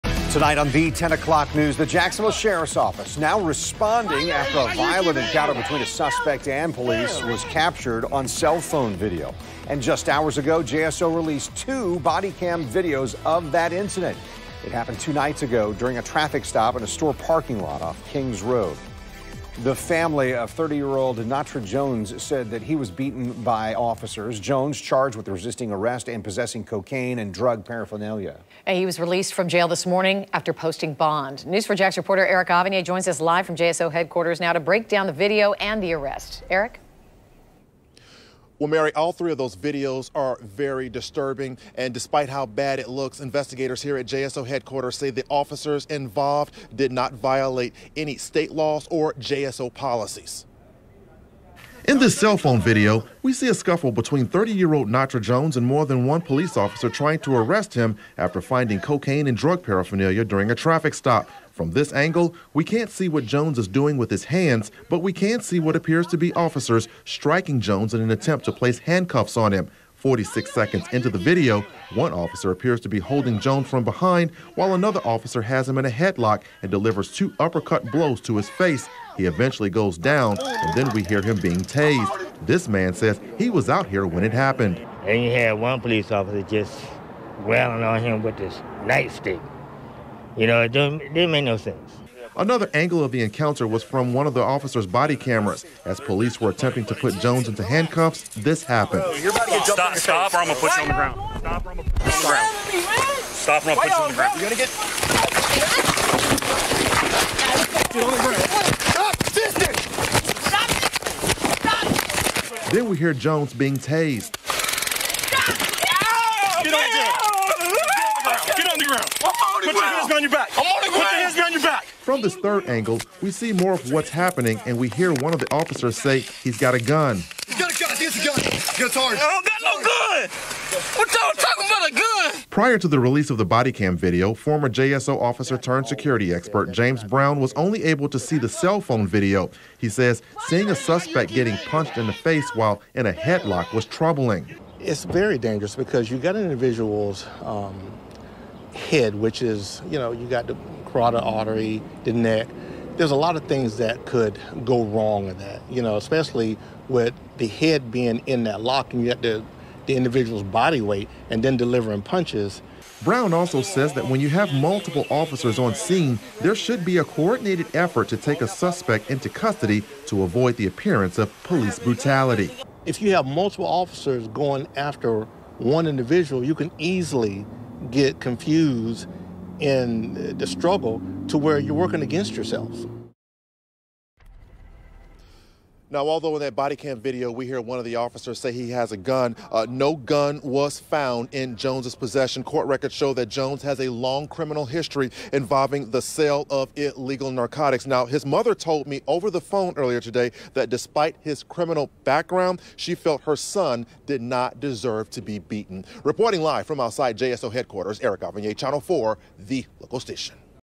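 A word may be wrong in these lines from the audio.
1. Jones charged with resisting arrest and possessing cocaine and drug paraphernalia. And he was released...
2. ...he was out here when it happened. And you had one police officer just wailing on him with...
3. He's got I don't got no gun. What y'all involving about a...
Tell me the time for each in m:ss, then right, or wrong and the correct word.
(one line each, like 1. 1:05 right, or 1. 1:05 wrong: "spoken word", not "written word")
1. 0:24 right
2. 1:23 right
3. 2:08 wrong: "talking", not "involving".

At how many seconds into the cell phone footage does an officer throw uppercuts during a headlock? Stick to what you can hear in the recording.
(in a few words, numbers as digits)
46.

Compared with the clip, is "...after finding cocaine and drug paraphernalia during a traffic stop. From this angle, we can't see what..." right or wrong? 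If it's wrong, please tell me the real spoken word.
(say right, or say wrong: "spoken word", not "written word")
right.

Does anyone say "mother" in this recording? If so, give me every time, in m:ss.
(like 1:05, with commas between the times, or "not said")
3:18.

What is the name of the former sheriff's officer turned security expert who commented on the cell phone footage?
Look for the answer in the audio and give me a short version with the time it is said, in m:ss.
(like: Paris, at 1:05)
James Brown, at 2:16.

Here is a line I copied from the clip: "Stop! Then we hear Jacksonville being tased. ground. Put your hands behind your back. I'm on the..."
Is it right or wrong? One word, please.
wrong.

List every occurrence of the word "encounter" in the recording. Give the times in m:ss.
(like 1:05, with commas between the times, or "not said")
0:05, 1:33.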